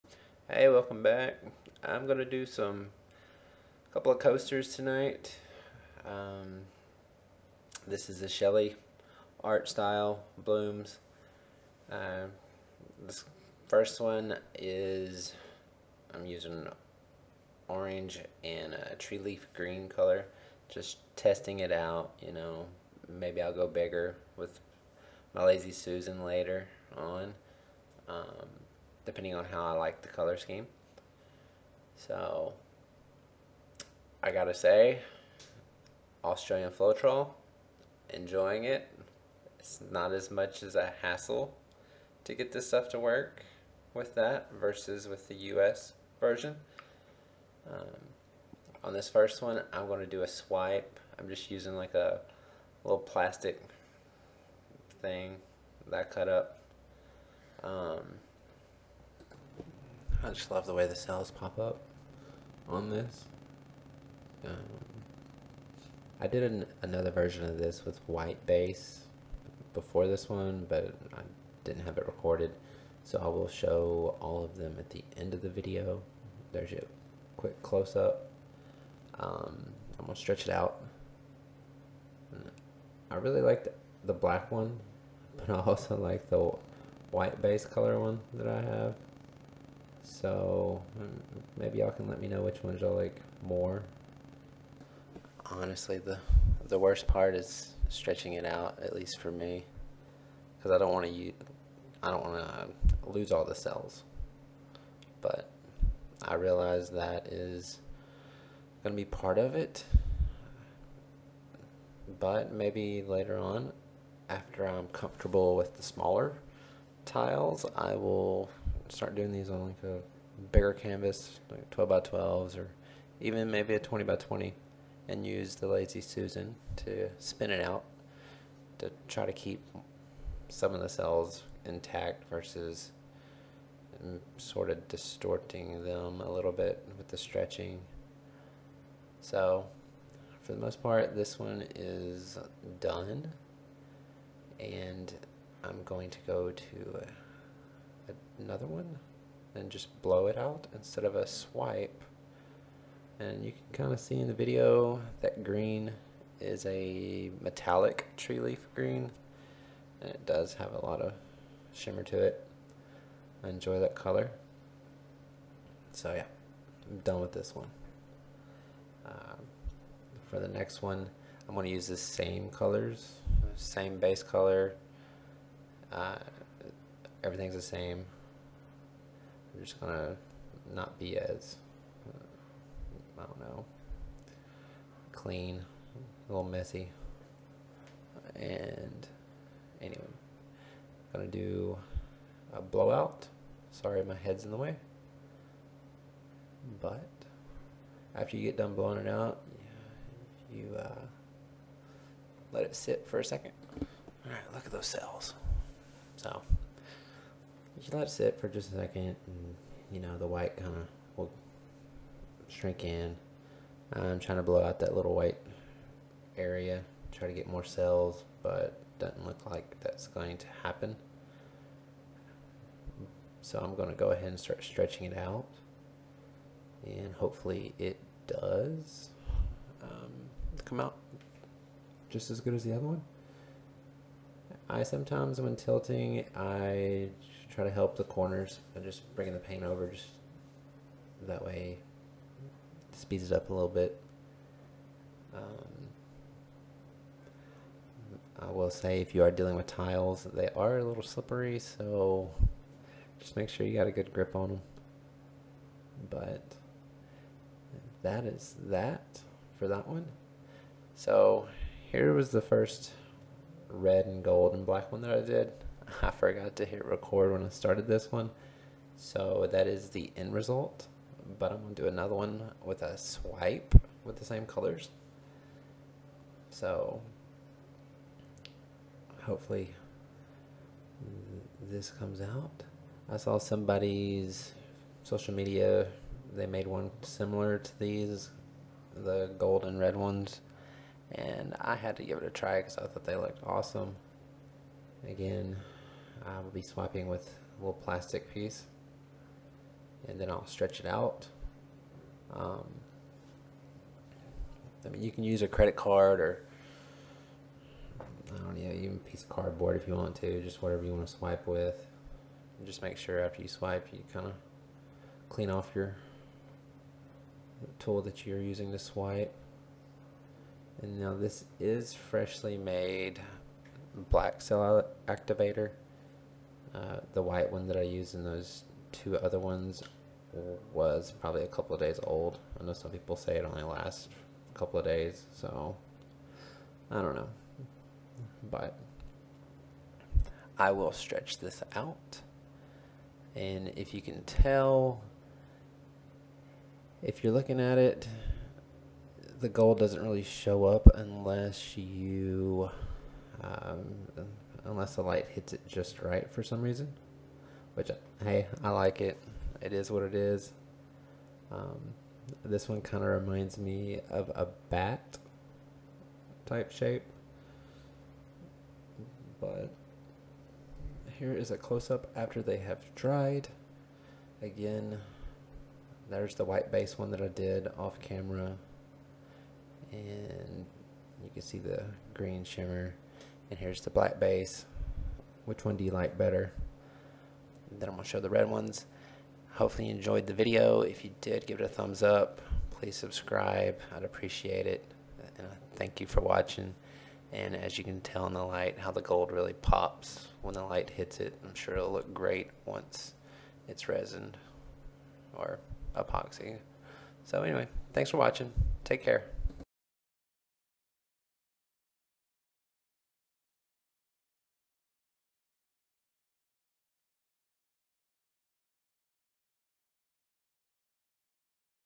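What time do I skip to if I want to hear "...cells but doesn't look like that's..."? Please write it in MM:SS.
03:37.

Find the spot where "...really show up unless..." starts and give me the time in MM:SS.
05:50.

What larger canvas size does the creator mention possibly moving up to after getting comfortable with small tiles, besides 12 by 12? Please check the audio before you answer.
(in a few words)
20 by 20.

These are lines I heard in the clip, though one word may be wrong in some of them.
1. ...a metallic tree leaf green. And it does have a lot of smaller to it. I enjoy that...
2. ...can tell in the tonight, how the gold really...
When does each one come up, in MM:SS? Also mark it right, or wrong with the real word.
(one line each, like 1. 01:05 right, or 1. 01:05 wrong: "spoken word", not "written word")
1. 02:36 wrong: "shimmer", not "smaller"
2. 06:37 wrong: "light", not "tonight".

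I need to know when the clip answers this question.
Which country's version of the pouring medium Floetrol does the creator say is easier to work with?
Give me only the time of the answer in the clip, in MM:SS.
00:36.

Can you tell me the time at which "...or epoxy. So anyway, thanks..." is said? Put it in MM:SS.
06:45.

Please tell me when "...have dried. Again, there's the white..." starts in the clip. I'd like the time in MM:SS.
06:12.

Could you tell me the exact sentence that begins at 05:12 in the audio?
And just make sure after you swipe, you kind of clean off your tool that you're using to swipe.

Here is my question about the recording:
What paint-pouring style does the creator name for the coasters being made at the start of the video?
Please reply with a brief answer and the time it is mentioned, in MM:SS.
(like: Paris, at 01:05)
Shelee art style blooms, at 00:08.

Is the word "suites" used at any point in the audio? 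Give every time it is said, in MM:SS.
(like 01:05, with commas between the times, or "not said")
not said.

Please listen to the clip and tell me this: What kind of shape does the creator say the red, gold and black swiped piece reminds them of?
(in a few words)
bat.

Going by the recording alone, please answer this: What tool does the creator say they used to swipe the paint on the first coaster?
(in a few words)
little plastic thing.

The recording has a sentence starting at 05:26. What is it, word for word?
Uh, the white one that I used in those two other ones was probably a couple of days old.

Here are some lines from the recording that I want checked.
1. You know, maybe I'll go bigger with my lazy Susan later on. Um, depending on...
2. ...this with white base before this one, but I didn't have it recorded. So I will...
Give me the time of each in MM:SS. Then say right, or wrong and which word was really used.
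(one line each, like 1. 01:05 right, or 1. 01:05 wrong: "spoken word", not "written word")
1. 00:22 right
2. 01:07 right.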